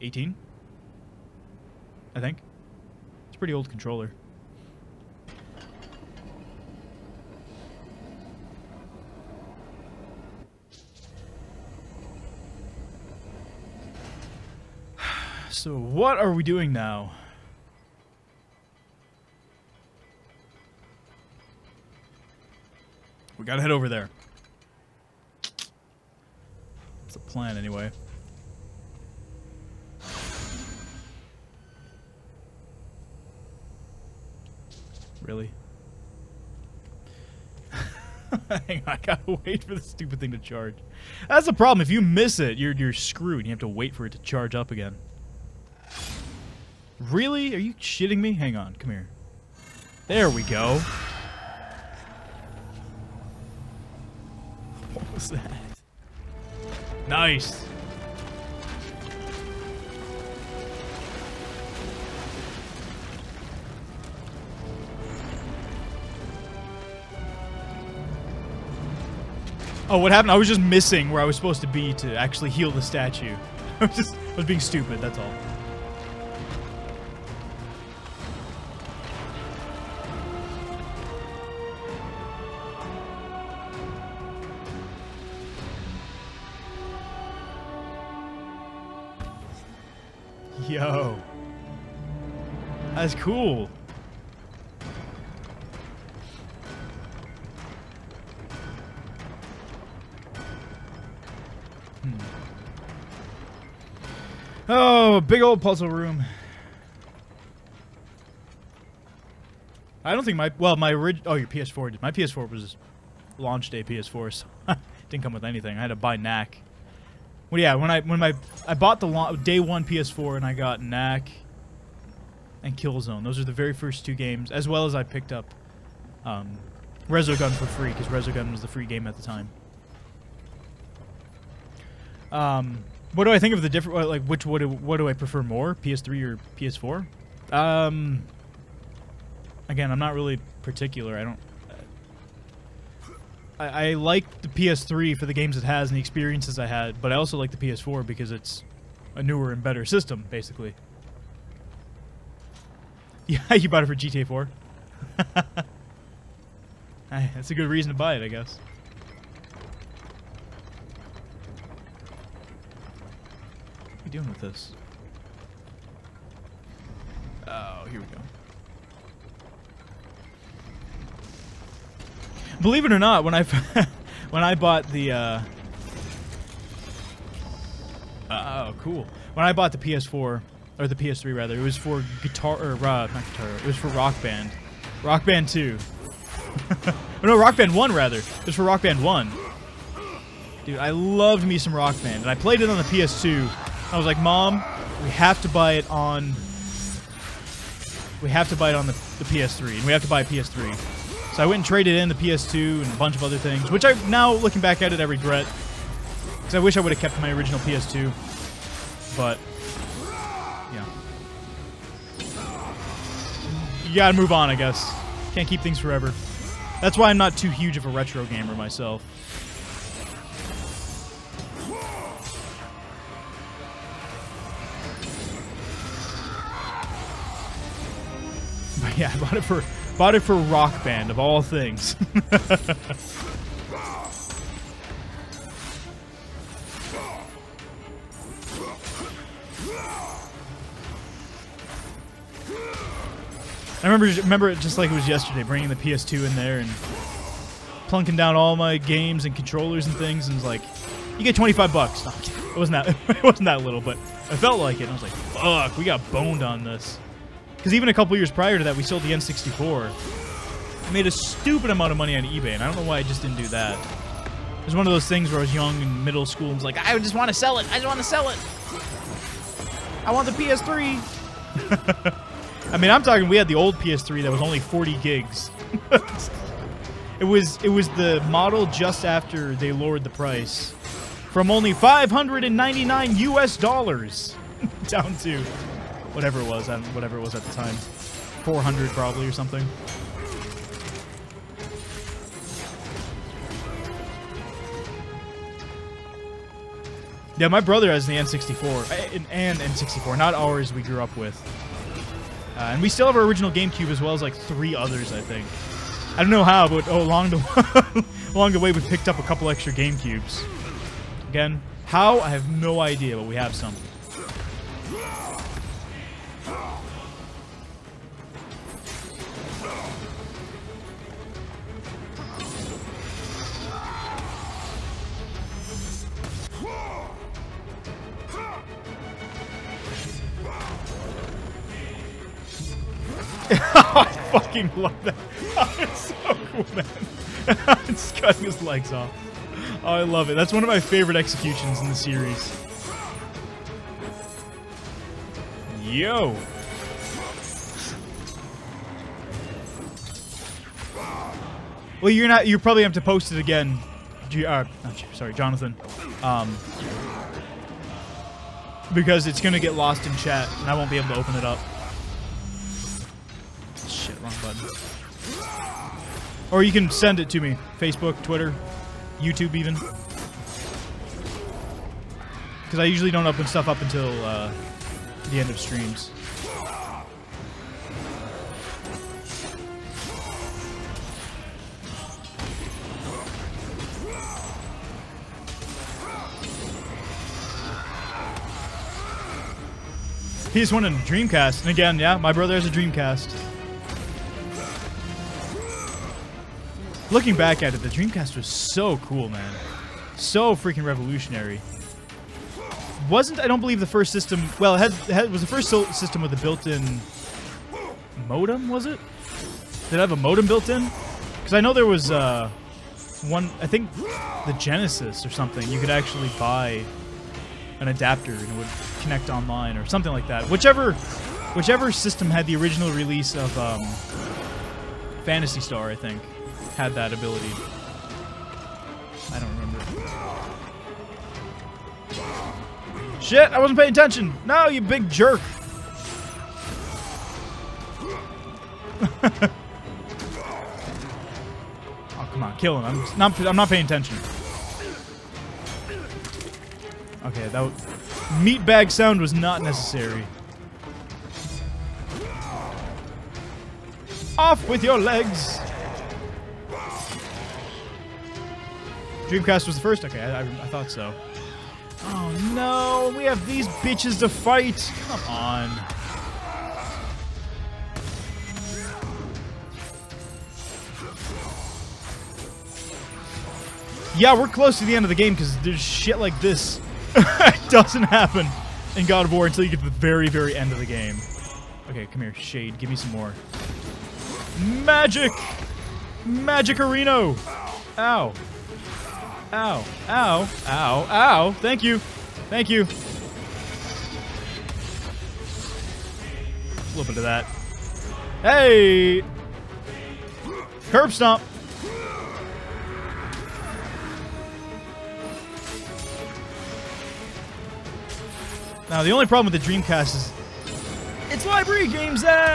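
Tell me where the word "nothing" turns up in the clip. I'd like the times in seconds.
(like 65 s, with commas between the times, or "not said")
not said.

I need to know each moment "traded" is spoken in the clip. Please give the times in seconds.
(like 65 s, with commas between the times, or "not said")
201 s.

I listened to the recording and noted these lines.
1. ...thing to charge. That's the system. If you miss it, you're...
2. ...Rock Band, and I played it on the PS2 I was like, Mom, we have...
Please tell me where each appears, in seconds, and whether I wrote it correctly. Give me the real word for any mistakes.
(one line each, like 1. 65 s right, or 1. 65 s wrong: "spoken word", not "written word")
1. 40 s wrong: "problem", not "system"
2. 191 s right.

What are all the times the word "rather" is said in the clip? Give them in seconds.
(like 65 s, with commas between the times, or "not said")
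181 s, 187 s.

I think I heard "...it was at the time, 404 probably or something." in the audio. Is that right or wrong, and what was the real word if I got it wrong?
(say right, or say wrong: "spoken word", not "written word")
wrong: "400", not "404".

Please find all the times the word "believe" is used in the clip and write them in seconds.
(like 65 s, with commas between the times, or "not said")
172 s, 403 s.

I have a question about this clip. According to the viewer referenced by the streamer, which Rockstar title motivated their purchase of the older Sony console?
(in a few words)
GTA 4.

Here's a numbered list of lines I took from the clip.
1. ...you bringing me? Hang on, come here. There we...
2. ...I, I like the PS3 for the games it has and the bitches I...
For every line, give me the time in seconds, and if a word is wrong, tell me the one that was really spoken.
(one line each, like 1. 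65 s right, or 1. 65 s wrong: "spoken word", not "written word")
1. 47 s wrong: "shitting", not "bringing"
2. 143 s wrong: "experiences", not "bitches".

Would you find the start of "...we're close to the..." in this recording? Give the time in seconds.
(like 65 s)
474 s.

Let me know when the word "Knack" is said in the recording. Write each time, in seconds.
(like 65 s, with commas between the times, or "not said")
116 s, 120 s.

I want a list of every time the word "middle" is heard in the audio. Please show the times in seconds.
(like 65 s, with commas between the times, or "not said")
266 s.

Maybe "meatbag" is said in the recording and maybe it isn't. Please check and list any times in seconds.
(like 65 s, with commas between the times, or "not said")
448 s.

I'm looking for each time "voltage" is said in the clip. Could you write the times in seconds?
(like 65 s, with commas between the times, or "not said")
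not said.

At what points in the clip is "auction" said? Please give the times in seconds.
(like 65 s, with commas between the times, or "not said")
not said.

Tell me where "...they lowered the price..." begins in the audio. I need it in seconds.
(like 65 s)
279 s.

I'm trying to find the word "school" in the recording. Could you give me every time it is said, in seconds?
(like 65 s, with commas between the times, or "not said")
266 s.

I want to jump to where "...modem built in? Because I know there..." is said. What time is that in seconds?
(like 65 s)
410 s.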